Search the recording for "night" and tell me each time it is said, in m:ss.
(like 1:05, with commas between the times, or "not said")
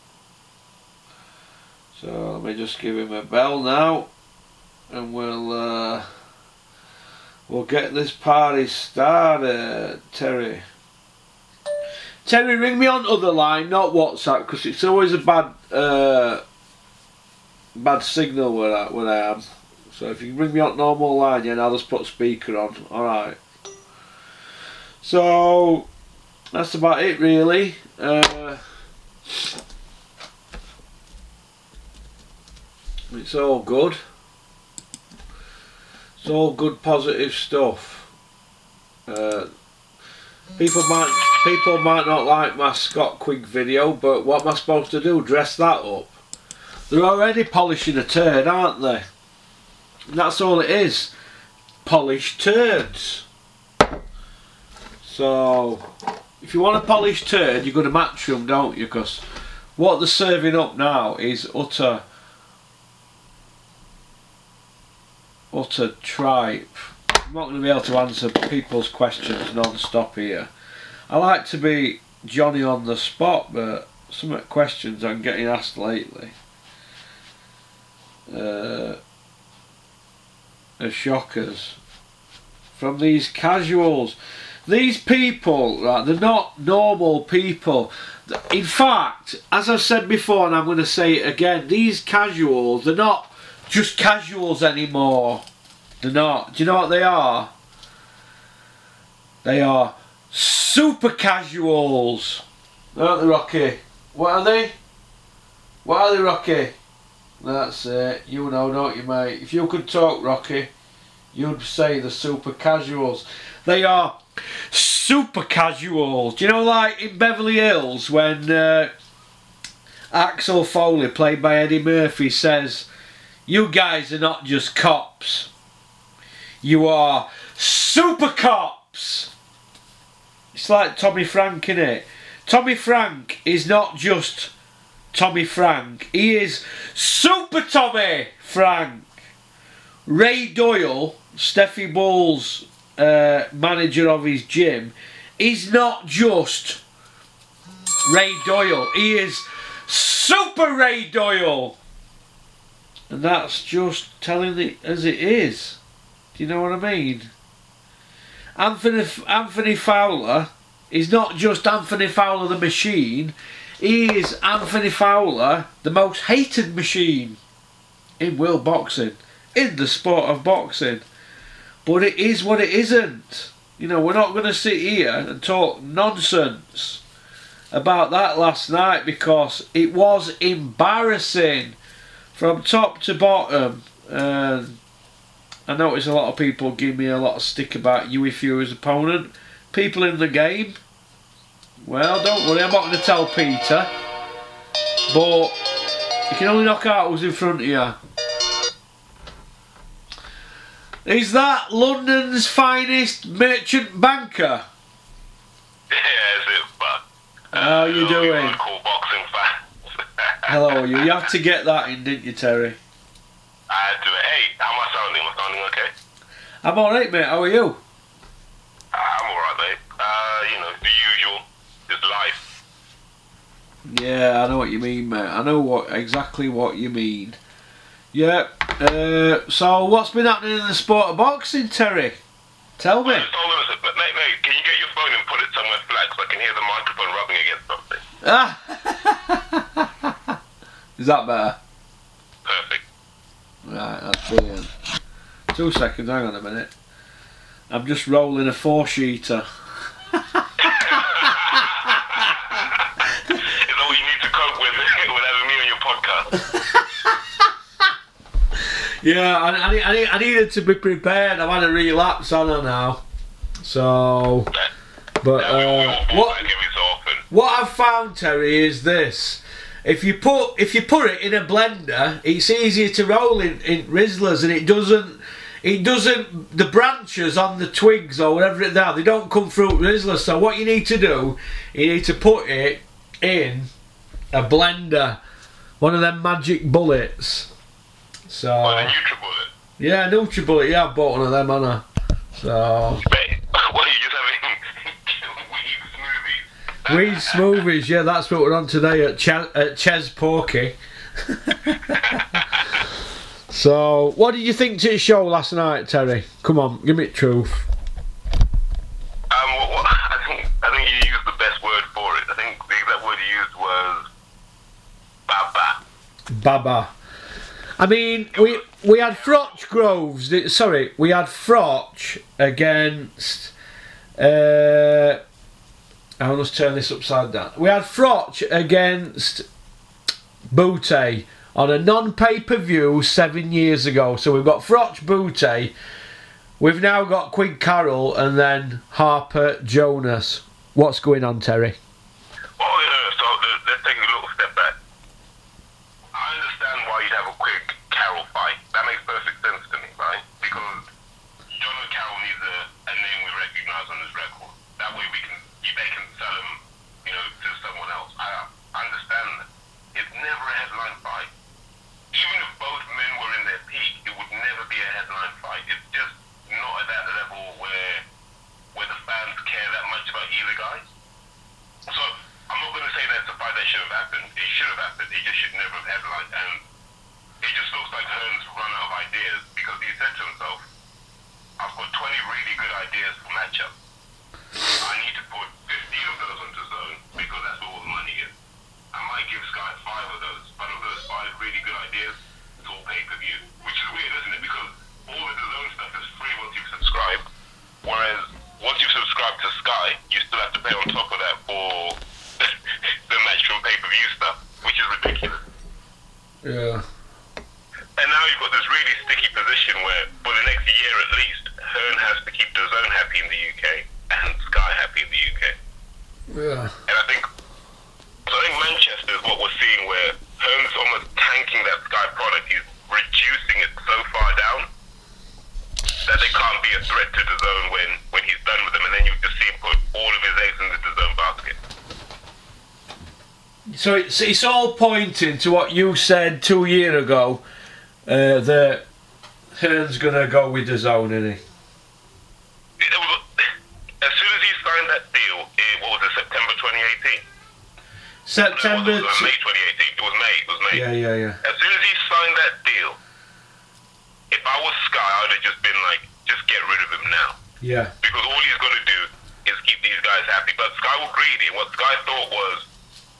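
2:58, 5:05.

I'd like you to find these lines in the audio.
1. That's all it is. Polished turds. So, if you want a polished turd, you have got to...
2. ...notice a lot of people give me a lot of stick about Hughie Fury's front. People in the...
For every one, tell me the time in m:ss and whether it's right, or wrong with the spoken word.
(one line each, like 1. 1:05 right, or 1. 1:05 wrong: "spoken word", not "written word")
1. 0:50 right
2. 3:05 wrong: "opponent", not "front".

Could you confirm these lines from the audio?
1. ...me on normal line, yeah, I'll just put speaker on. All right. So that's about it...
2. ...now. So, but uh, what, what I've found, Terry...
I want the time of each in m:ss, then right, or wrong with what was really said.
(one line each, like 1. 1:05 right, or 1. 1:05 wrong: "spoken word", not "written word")
1. 0:20 right
2. 4:22 right.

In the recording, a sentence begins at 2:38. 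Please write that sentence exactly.
Anthony, Anthony Fowler is not just Anthony Fowler the Machine.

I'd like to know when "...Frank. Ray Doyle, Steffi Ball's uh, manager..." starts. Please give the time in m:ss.
2:18.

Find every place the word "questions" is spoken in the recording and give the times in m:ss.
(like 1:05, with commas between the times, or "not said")
1:08, 1:14.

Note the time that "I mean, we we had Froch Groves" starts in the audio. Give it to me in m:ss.
5:17.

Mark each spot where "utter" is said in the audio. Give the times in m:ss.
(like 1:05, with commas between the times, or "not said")
1:01, 1:05.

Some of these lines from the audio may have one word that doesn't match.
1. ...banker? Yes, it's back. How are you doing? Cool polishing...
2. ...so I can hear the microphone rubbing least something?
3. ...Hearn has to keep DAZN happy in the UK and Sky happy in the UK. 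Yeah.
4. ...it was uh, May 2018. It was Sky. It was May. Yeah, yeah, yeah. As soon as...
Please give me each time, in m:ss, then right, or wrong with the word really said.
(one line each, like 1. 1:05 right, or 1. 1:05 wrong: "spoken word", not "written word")
1. 3:23 wrong: "boxing", not "polishing"
2. 3:58 wrong: "against", not "least"
3. 6:51 right
4. 7:28 wrong: "May", not "Sky".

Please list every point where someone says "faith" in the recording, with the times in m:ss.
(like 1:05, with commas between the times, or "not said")
not said.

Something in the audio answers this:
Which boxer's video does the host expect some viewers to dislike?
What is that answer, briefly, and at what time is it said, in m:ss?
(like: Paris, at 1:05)
Scott Quigg, at 0:42.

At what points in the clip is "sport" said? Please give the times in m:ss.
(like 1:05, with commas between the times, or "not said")
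2:49, 3:50.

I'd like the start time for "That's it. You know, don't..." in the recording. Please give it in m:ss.
1:47.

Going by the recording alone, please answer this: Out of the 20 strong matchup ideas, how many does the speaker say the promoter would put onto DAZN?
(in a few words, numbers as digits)
15.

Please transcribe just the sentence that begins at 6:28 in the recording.
I might give Sky five of those, but of those five really good ideas, it's all pay per view.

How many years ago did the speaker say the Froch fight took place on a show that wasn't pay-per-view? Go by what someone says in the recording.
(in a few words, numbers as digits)
7.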